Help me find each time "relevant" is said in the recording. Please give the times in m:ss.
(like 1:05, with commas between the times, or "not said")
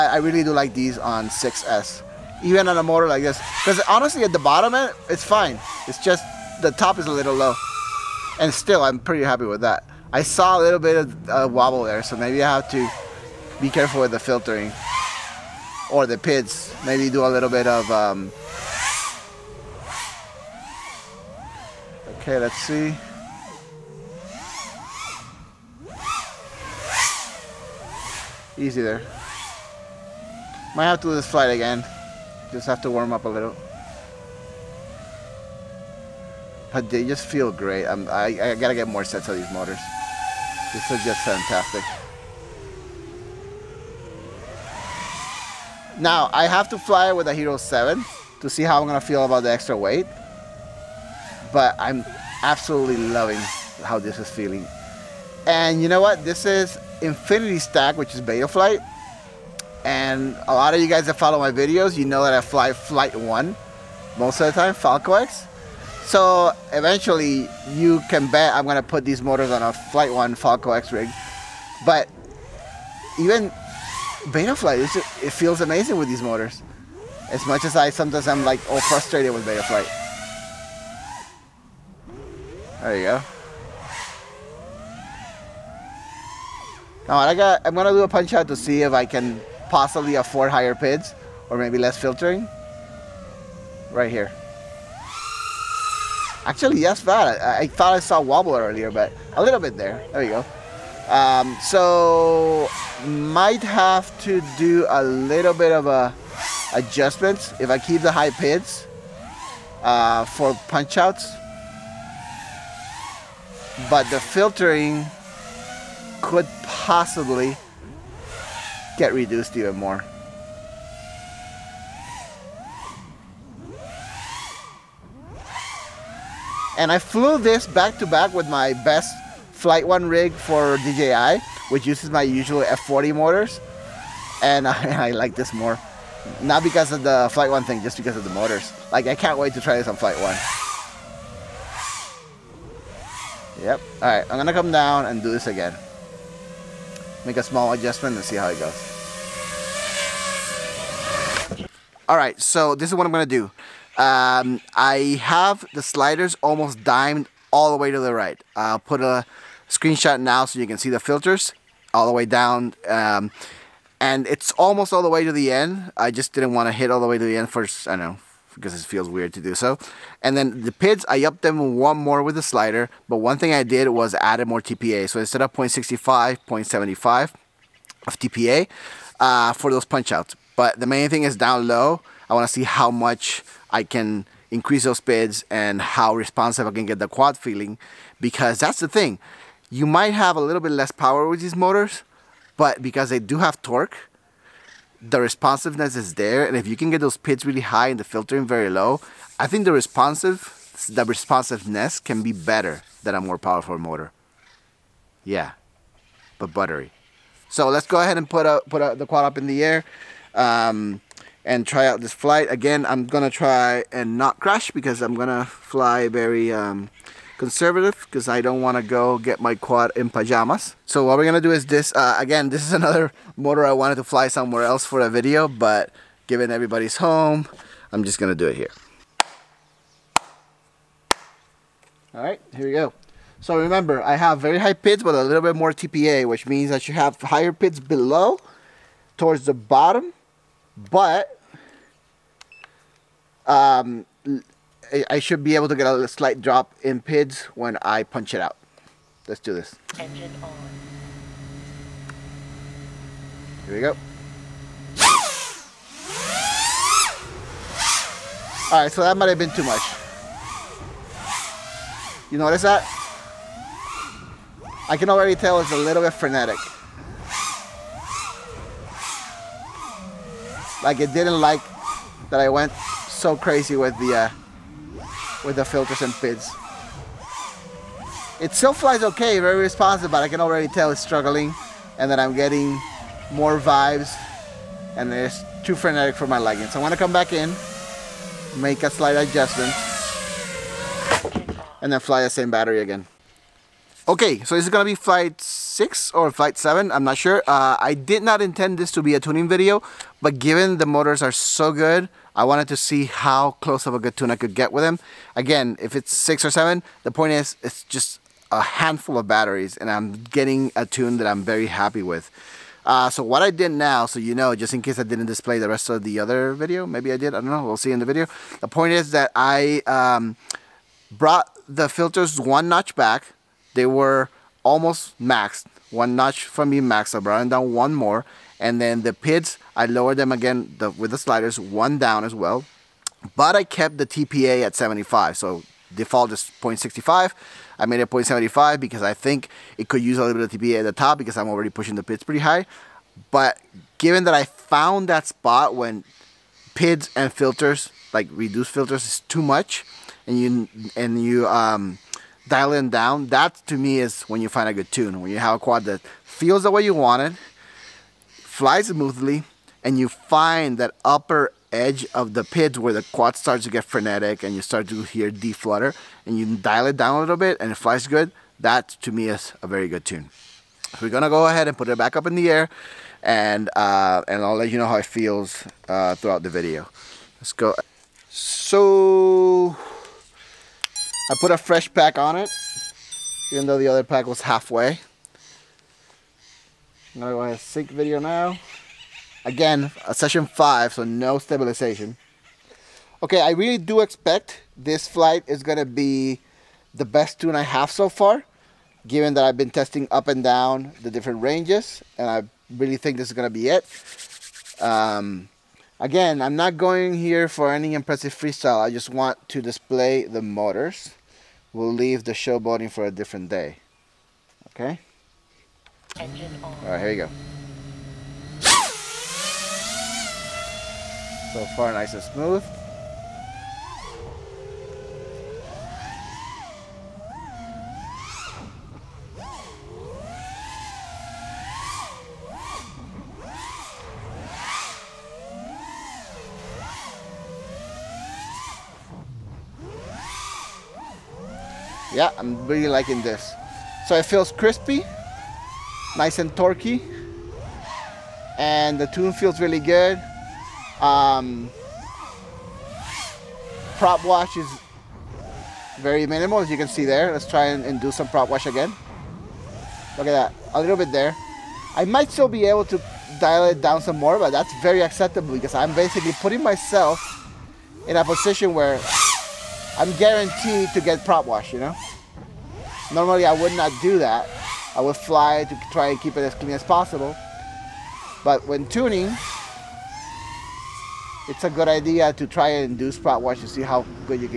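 not said.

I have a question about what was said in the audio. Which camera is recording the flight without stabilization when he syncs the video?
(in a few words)
Session 5.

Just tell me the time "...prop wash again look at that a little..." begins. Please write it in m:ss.
7:38.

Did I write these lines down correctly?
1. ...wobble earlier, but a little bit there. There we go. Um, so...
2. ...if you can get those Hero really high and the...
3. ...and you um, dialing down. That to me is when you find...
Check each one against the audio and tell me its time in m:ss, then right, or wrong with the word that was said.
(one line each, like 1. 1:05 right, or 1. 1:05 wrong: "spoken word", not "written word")
1. 1:38 right
2. 3:16 wrong: "PIDs", not "Hero"
3. 5:50 right.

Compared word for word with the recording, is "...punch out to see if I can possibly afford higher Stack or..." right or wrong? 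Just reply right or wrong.
wrong.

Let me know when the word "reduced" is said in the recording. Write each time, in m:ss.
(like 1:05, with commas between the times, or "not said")
1:59, 5:48.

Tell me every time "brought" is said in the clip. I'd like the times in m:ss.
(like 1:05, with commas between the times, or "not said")
5:21, 5:27.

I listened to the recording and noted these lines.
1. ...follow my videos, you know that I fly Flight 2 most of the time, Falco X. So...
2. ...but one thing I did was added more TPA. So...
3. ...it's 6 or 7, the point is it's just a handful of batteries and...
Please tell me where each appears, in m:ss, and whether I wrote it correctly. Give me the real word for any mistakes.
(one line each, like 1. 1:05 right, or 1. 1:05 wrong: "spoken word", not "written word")
1. 1:01 wrong: "1", not "2"
2. 2:53 right
3. 5:05 right.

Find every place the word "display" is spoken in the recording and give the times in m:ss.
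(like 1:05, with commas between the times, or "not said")
5:15, 6:49.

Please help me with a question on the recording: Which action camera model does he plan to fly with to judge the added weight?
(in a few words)
Hero 7.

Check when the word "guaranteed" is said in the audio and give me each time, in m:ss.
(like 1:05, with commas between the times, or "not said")
7:50.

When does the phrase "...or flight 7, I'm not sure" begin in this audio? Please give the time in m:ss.
4:56.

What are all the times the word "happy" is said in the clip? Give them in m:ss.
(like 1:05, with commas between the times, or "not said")
0:09, 5:11.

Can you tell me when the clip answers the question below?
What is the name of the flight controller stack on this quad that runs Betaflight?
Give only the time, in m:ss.
0:57.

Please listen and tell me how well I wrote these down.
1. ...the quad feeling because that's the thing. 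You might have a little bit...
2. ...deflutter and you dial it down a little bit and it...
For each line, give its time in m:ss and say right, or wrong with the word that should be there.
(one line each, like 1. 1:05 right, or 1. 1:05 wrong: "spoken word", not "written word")
1. 3:06 right
2. 6:05 right.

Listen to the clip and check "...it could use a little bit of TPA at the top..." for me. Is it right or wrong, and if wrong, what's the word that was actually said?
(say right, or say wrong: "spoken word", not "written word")
right.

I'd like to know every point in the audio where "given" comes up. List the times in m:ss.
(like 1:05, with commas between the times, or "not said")
3:46, 5:00, 5:43, 6:39.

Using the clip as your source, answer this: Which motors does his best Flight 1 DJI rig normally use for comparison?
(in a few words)
F40 motors.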